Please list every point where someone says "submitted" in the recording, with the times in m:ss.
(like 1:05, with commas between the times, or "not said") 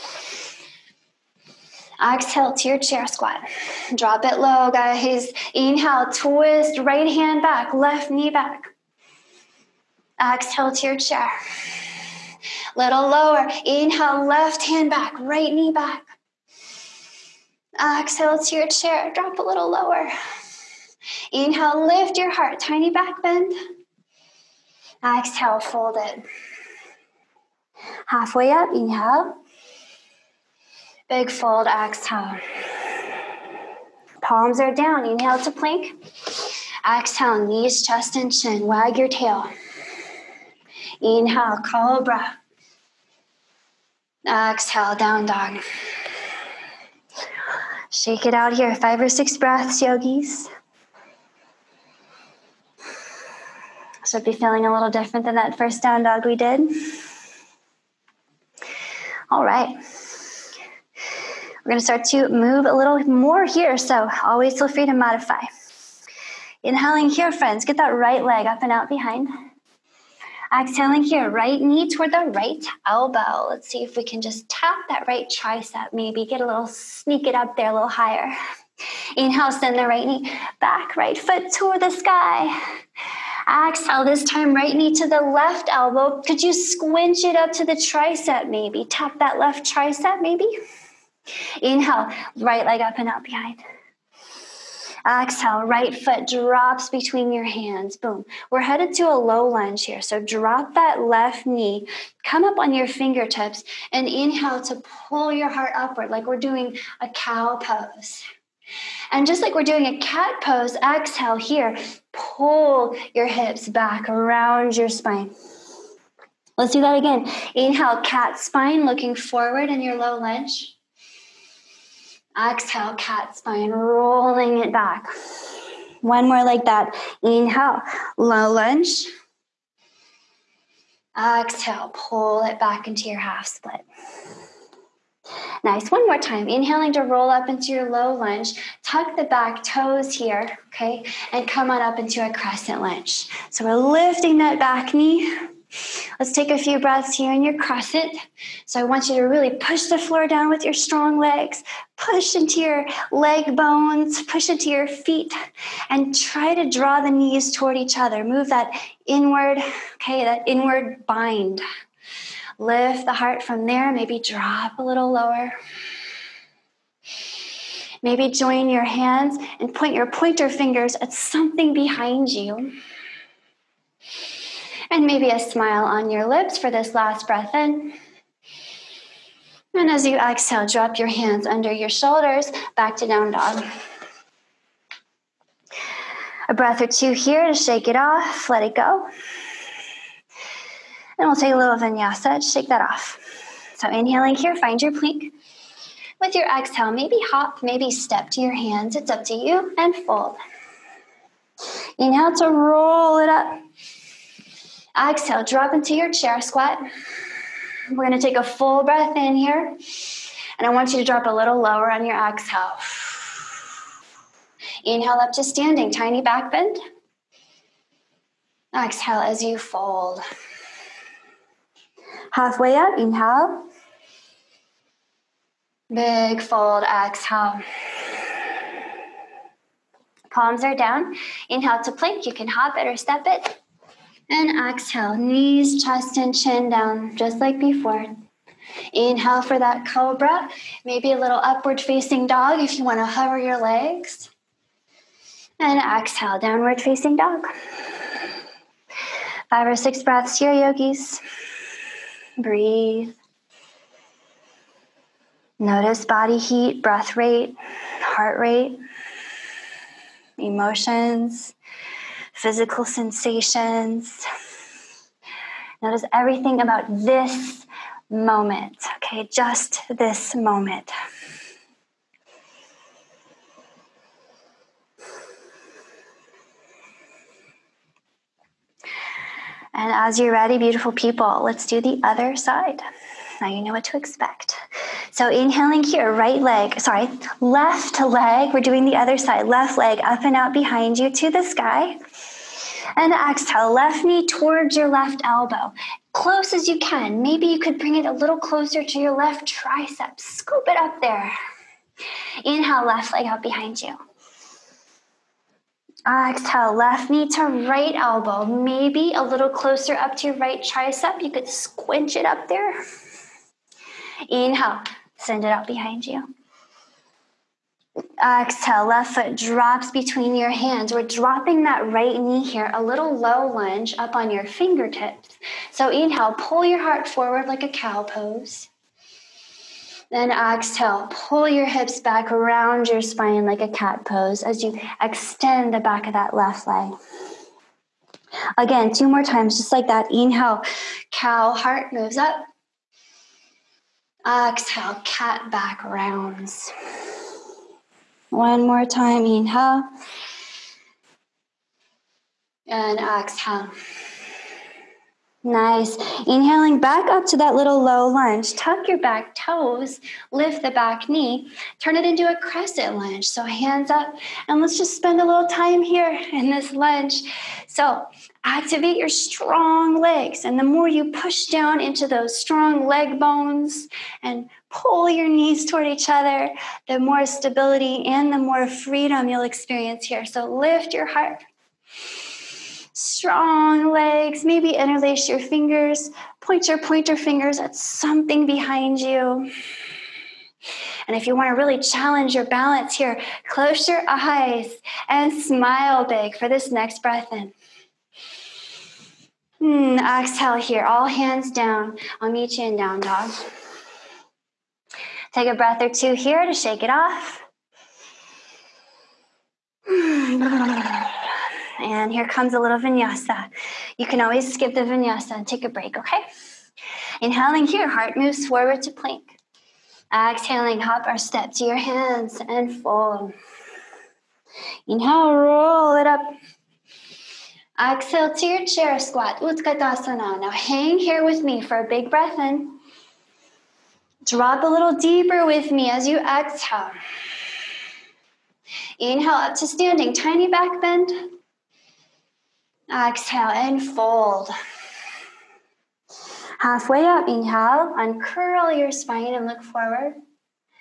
not said.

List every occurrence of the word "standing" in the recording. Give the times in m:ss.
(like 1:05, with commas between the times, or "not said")
3:35, 7:19.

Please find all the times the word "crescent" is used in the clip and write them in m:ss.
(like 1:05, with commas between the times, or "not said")
2:22, 6:02.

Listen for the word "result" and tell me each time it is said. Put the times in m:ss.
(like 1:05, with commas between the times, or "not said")
not said.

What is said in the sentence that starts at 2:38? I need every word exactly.
Move that inward, okay, that inward bind.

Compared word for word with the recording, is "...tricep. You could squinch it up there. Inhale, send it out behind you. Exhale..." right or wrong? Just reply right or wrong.
right.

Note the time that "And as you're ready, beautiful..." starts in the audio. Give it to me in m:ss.
4:39.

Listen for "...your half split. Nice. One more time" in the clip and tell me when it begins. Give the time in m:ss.
2:13.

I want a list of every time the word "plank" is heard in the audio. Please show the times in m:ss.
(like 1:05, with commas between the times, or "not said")
0:35, 3:14, 3:51, 6:58.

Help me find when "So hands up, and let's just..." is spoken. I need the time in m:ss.
6:03.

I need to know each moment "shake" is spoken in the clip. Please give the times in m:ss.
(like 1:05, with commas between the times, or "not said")
0:47, 3:07, 3:12, 6:46.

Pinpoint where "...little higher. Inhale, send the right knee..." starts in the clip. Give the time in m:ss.
1:17.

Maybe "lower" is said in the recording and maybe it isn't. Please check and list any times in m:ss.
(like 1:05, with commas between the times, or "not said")
0:13, 0:19, 2:45, 3:31.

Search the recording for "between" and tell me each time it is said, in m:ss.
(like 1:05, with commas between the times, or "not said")
1:36, 5:19.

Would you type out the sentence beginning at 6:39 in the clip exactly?
Mm, exhale here, all hands down.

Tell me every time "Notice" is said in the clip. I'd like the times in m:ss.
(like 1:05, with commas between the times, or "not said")
4:15, 4:25.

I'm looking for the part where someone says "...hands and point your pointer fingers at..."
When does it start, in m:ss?
2:48.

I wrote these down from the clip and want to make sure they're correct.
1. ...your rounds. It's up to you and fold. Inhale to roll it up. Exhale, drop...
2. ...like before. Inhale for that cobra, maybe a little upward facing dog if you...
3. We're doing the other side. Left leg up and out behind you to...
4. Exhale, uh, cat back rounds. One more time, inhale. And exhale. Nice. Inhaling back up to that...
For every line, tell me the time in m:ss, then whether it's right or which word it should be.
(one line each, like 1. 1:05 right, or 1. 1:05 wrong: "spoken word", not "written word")
1. 3:18 wrong: "hands", not "rounds"
2. 3:57 right
3. 4:48 right
4. 5:44 right.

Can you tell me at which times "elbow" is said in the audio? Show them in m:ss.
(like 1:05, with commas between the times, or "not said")
1:12, 1:25, 4:55, 5:07.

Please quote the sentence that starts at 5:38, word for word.
Again, two more times, just like that.